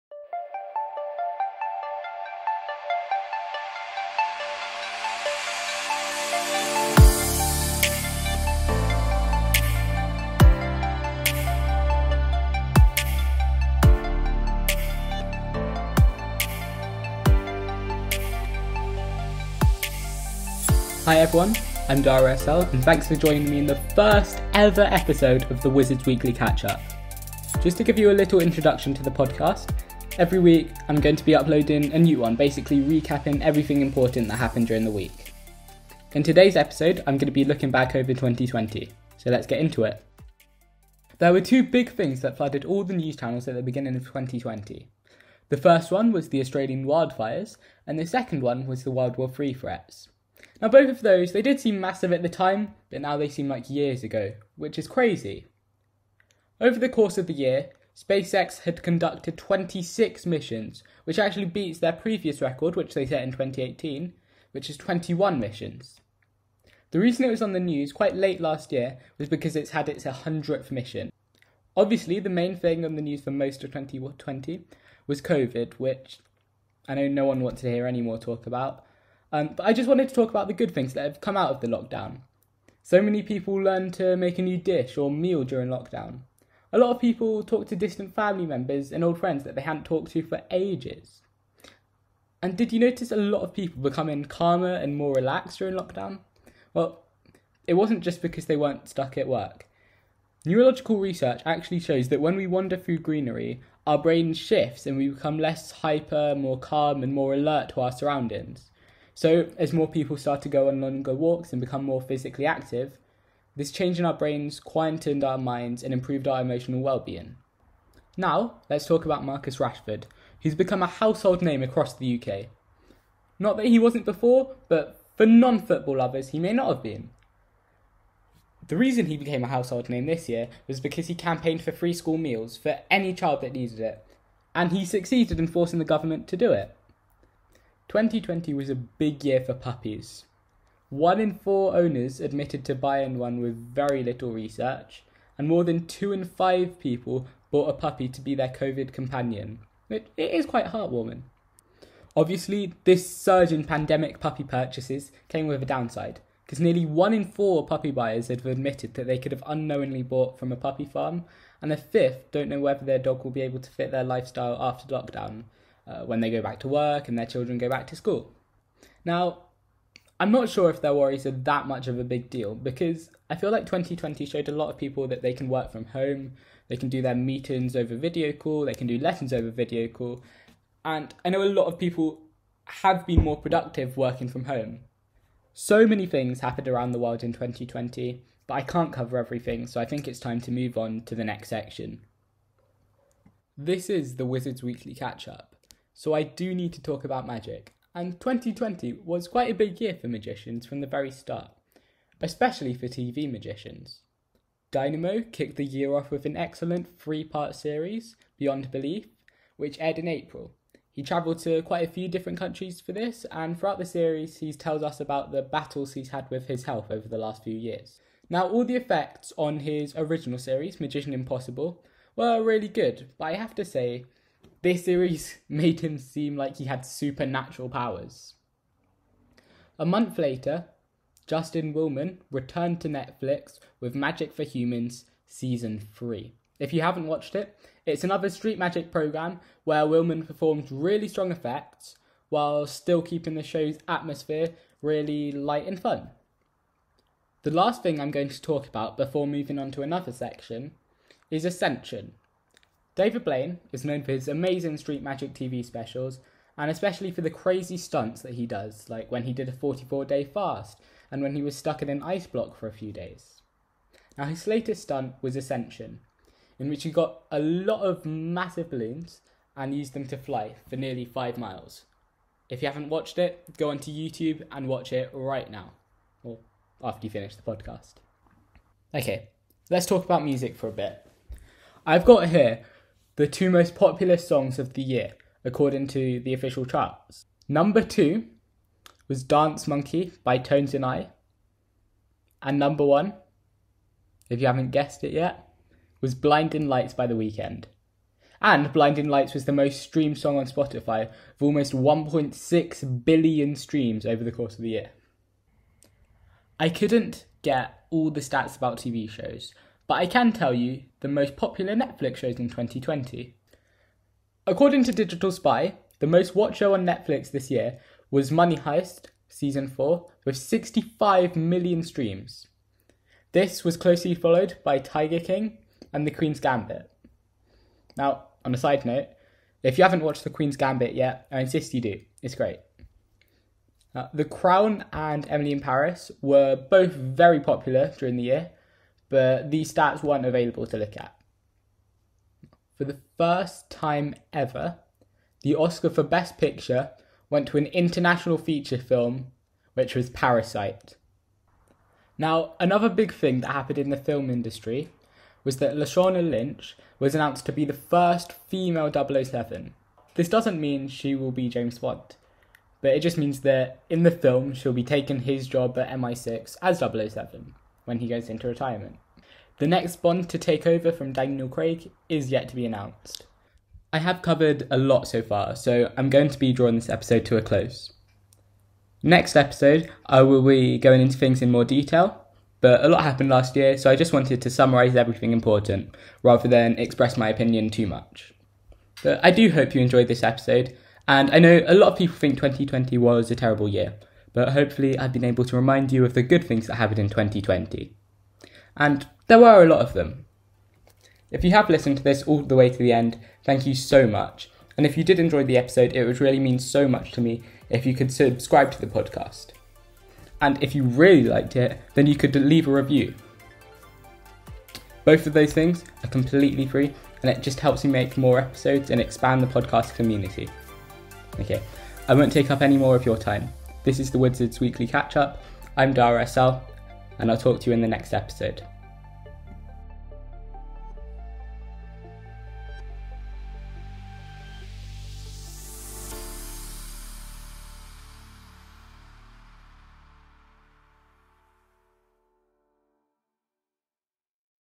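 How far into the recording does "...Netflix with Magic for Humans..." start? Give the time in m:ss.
3:52.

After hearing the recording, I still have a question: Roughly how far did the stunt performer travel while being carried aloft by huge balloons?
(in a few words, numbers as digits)
nearly 5 miles.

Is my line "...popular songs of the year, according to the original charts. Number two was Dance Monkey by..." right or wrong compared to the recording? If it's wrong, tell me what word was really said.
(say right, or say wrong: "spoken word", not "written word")
wrong: "official", not "original".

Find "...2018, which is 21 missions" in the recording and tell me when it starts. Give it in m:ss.
1:03.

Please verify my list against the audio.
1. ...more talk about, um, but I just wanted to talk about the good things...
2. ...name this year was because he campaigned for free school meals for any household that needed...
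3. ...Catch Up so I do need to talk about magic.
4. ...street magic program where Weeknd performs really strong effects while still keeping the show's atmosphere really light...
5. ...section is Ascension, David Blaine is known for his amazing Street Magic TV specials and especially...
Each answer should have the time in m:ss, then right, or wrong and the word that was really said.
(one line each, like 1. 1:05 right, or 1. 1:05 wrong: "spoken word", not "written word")
1. 1:18 right
2. 2:09 wrong: "child", not "household"
3. 3:14 right
4. 3:58 wrong: "Willman", not "Weeknd"
5. 4:10 right.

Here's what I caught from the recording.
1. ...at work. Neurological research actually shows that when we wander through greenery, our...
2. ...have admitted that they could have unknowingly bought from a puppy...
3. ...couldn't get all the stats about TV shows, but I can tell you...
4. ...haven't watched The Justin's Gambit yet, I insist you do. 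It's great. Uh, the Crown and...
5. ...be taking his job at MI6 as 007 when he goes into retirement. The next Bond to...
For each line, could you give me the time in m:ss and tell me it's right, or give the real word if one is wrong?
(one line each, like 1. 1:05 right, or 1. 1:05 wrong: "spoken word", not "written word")
1. 1:39 right
2. 2:38 right
3. 5:06 right
4. 5:29 wrong: "Queen", not "Justin"
5. 6:04 right.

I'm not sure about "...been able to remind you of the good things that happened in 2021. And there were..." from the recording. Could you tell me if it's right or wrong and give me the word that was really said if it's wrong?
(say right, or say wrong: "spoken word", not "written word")
wrong: "2020", not "2021".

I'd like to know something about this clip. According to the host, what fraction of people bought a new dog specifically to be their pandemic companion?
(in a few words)
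more than two in five.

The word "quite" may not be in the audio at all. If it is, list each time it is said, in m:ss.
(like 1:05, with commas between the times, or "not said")
1:07, 2:30, 3:19, 3:31.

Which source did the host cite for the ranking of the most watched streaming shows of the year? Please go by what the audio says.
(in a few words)
Digital Spy.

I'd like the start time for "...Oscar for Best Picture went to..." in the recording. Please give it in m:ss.
5:45.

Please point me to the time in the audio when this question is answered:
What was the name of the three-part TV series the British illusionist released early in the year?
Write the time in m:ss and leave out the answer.
3:28.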